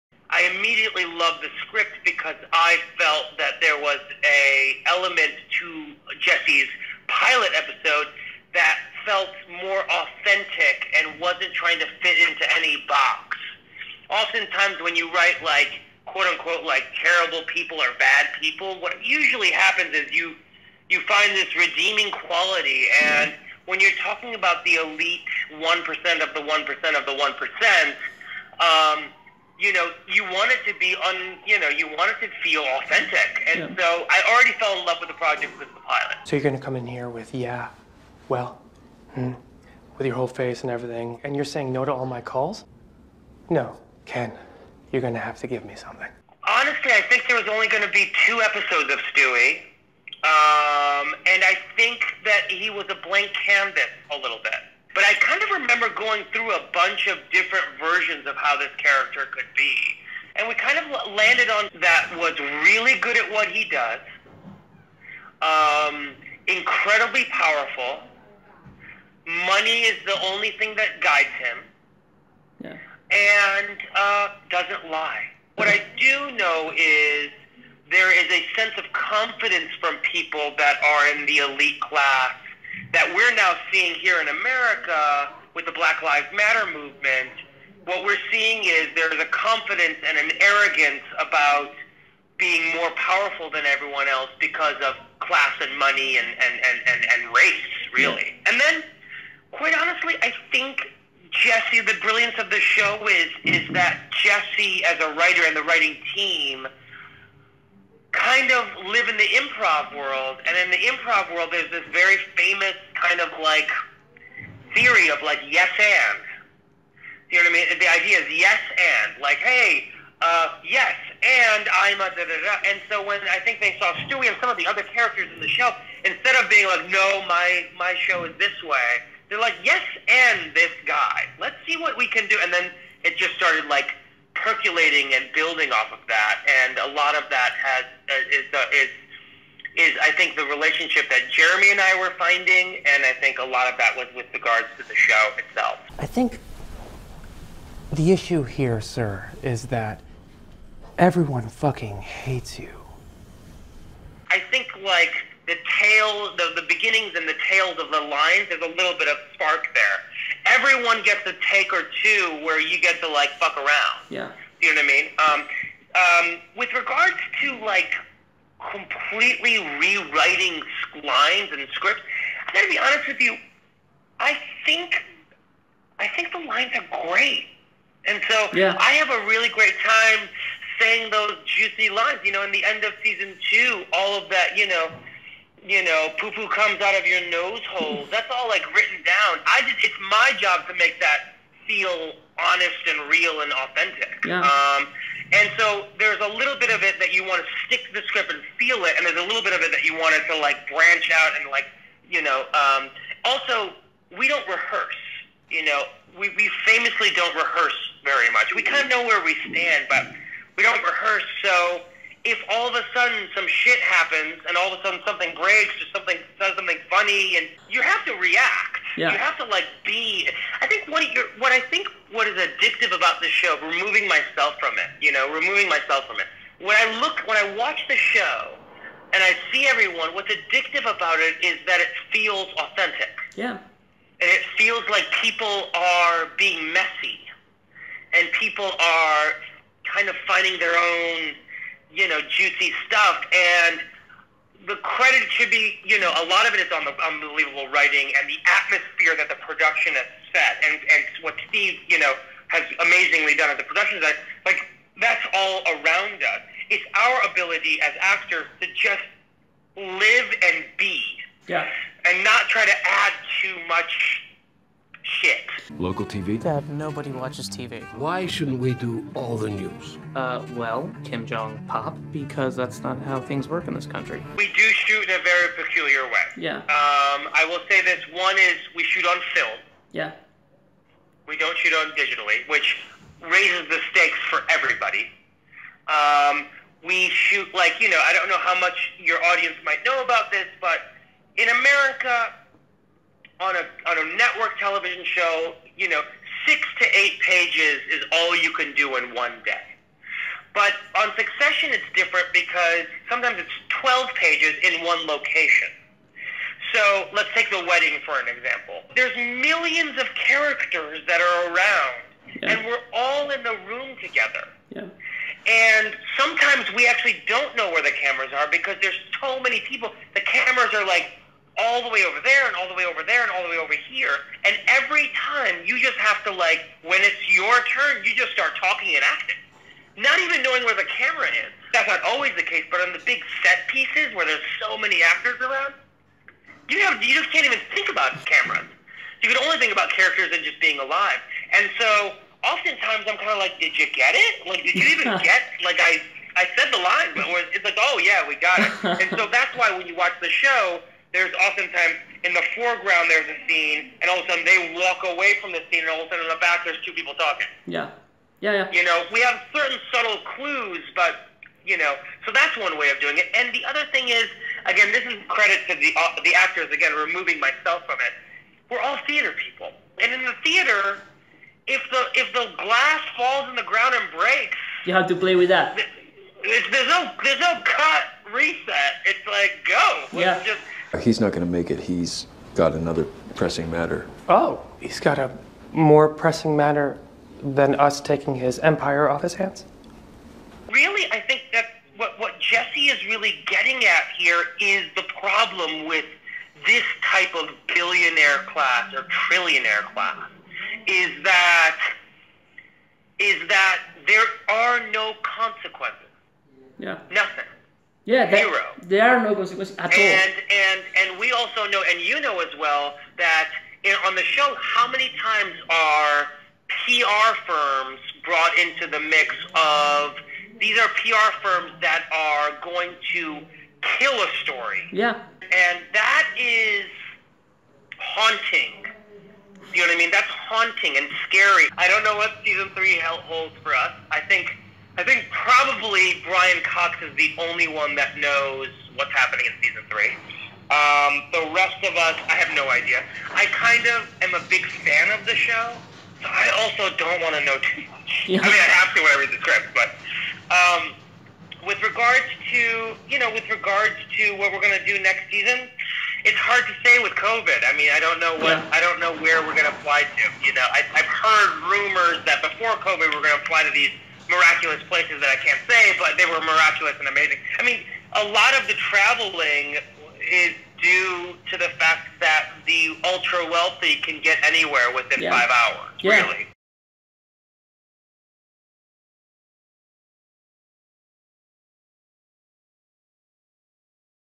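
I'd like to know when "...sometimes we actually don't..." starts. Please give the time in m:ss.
5:16.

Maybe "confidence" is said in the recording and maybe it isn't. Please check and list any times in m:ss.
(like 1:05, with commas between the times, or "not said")
1:18, 1:29.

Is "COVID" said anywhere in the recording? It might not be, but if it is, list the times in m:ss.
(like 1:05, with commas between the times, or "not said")
7:37, 7:42.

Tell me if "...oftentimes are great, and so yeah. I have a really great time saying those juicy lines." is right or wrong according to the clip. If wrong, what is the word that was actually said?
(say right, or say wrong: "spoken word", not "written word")
wrong: "lines", not "oftentimes".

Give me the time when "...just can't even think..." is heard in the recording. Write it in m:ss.
5:37.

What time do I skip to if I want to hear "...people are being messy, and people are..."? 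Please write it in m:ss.
3:55.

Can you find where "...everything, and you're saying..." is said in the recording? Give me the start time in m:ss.
0:40.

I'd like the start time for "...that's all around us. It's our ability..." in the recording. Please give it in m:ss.
4:14.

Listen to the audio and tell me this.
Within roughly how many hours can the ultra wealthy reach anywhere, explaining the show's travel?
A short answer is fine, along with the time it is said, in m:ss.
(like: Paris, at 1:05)
5, at 7:55.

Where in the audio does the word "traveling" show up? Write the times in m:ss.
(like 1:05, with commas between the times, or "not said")
7:48.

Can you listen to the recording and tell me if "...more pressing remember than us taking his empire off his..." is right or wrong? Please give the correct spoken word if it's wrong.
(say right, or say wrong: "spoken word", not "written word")
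wrong: "matter", not "remember".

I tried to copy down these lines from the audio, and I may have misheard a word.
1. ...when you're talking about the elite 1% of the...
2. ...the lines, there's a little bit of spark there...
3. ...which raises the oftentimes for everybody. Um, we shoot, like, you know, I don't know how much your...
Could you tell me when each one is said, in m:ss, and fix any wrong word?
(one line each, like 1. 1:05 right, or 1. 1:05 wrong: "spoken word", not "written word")
1. 0:23 right
2. 2:37 right
3. 4:42 wrong: "stakes", not "oftentimes".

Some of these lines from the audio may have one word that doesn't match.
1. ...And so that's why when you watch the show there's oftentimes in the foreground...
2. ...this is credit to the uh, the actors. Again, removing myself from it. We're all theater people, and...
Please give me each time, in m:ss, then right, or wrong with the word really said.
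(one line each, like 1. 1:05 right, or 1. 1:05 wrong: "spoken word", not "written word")
1. 5:49 right
2. 6:04 right.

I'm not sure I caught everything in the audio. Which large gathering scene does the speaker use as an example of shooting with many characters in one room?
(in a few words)
the wedding.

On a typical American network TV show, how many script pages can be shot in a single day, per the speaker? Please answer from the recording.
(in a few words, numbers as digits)
6 to 8.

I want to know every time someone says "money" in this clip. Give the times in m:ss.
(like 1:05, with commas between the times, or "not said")
1:09, 1:35.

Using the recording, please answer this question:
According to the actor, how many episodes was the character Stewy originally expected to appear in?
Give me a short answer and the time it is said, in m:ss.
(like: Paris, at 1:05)
2, at 0:48.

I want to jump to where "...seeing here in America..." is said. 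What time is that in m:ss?
1:23.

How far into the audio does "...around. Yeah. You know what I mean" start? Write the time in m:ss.
2:43.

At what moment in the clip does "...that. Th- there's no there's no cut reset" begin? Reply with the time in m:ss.
6:15.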